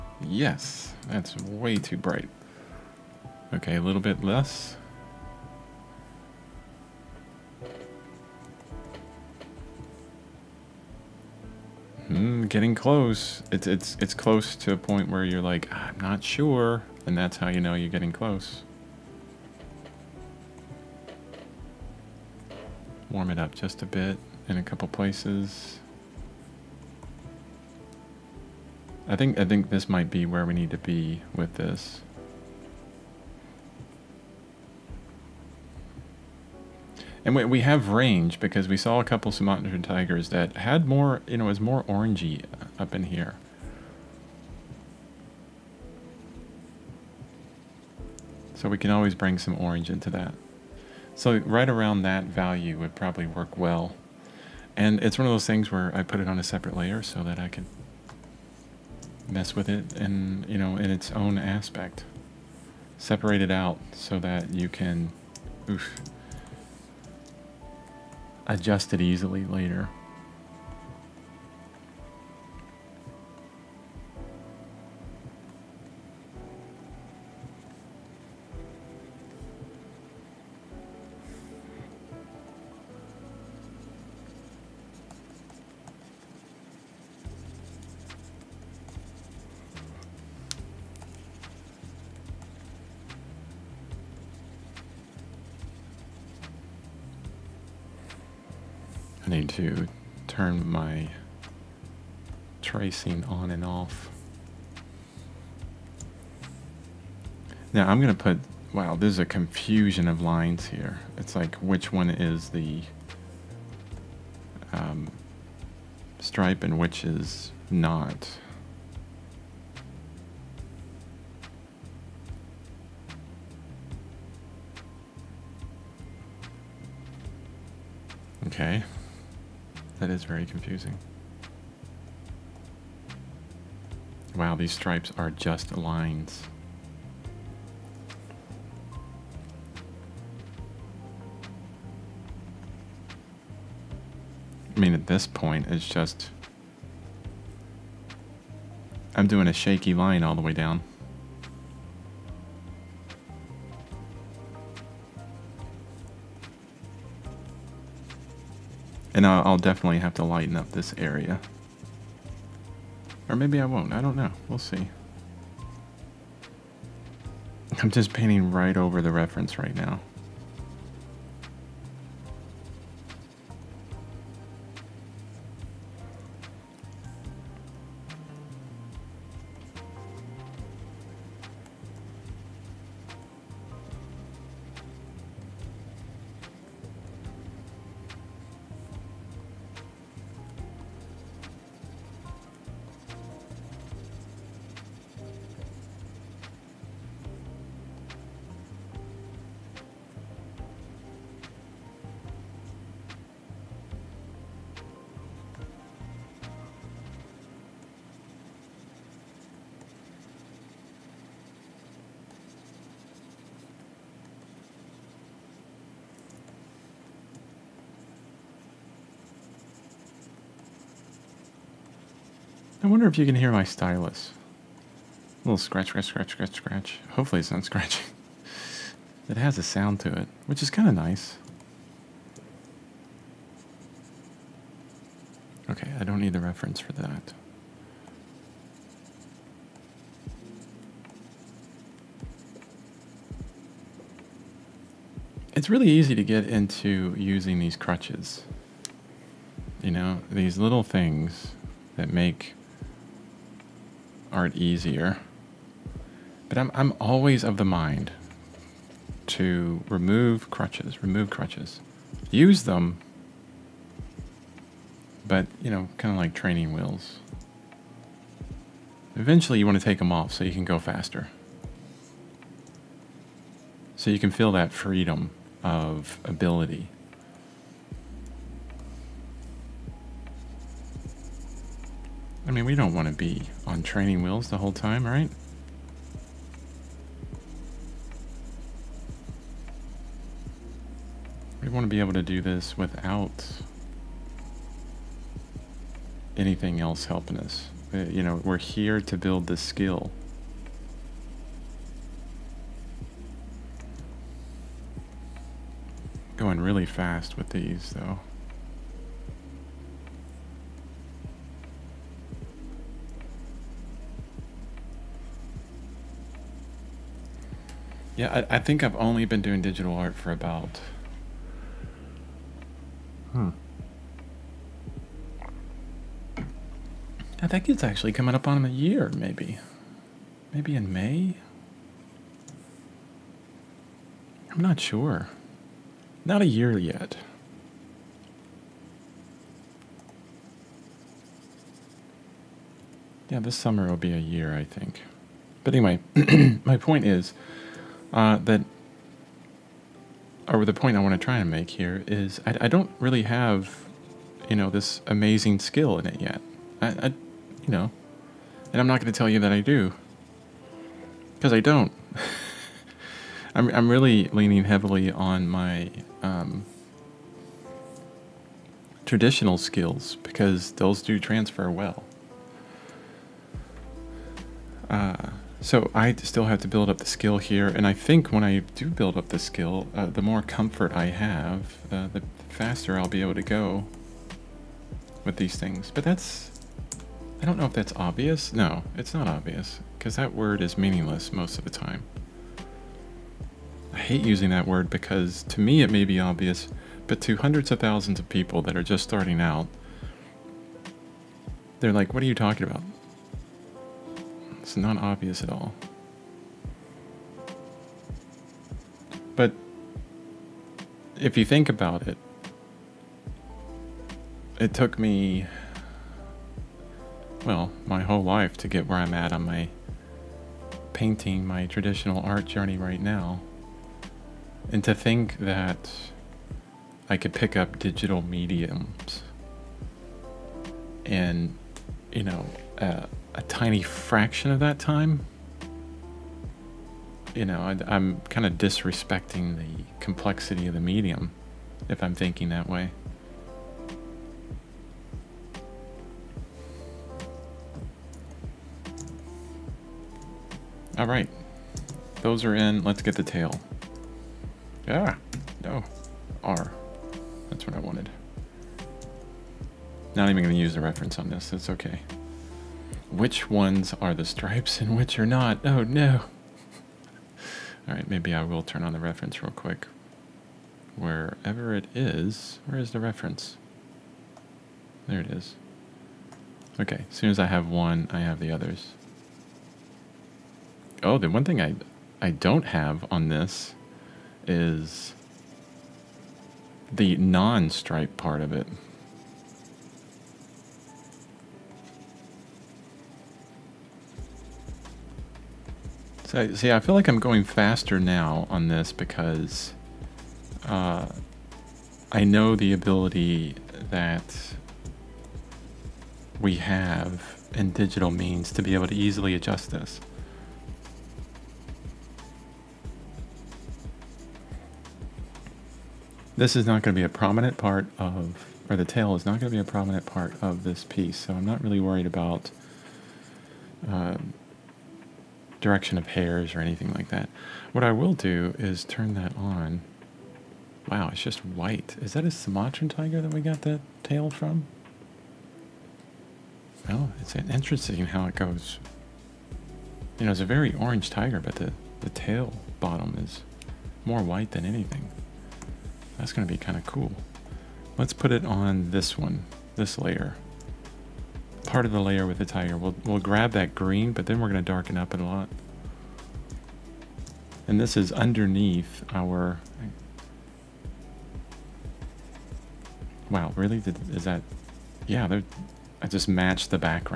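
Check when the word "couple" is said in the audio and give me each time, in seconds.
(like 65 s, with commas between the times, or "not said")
24 s, 39 s.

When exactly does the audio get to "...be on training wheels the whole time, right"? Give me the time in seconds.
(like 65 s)
283 s.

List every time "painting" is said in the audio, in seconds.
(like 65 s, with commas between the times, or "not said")
168 s, 420 s.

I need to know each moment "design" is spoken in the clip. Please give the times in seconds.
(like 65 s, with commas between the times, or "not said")
not said.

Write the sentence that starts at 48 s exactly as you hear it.
So we can always bring some orange into that.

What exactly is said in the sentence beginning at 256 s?
But I'm, I'm always of the mind to remove crutches, remove crutches.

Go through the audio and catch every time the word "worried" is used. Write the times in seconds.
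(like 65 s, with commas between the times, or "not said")
521 s.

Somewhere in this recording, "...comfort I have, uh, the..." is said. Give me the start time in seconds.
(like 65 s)
380 s.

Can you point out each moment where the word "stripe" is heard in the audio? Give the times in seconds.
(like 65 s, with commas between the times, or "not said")
116 s, 134 s, 464 s, 487 s.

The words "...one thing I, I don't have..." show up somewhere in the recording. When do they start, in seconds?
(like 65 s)
481 s.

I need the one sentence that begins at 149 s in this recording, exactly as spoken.
I'm doing a shaky line all the way down.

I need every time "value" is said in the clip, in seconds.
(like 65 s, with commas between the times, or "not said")
52 s.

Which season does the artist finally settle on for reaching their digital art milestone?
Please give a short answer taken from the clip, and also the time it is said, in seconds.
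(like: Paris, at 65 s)
Summer, at 343 s.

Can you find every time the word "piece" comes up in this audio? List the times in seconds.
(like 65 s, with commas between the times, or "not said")
520 s.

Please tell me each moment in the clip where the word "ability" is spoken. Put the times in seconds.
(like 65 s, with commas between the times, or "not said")
276 s, 502 s.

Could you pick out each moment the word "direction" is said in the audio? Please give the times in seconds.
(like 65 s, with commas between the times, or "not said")
525 s.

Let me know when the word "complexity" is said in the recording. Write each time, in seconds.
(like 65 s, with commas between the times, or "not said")
439 s.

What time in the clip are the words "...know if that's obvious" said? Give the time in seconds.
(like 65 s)
387 s.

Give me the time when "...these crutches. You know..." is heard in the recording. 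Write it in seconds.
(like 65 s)
247 s.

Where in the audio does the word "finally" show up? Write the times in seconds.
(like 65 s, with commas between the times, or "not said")
not said.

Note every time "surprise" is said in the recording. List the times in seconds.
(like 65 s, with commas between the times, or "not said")
not said.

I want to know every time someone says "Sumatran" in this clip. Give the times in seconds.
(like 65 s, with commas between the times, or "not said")
39 s, 532 s.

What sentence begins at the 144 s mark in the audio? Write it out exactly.
I mean, at this point, it's just...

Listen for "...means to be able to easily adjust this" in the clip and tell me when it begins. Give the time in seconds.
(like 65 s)
508 s.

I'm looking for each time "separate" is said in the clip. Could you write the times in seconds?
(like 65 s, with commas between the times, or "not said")
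56 s, 62 s.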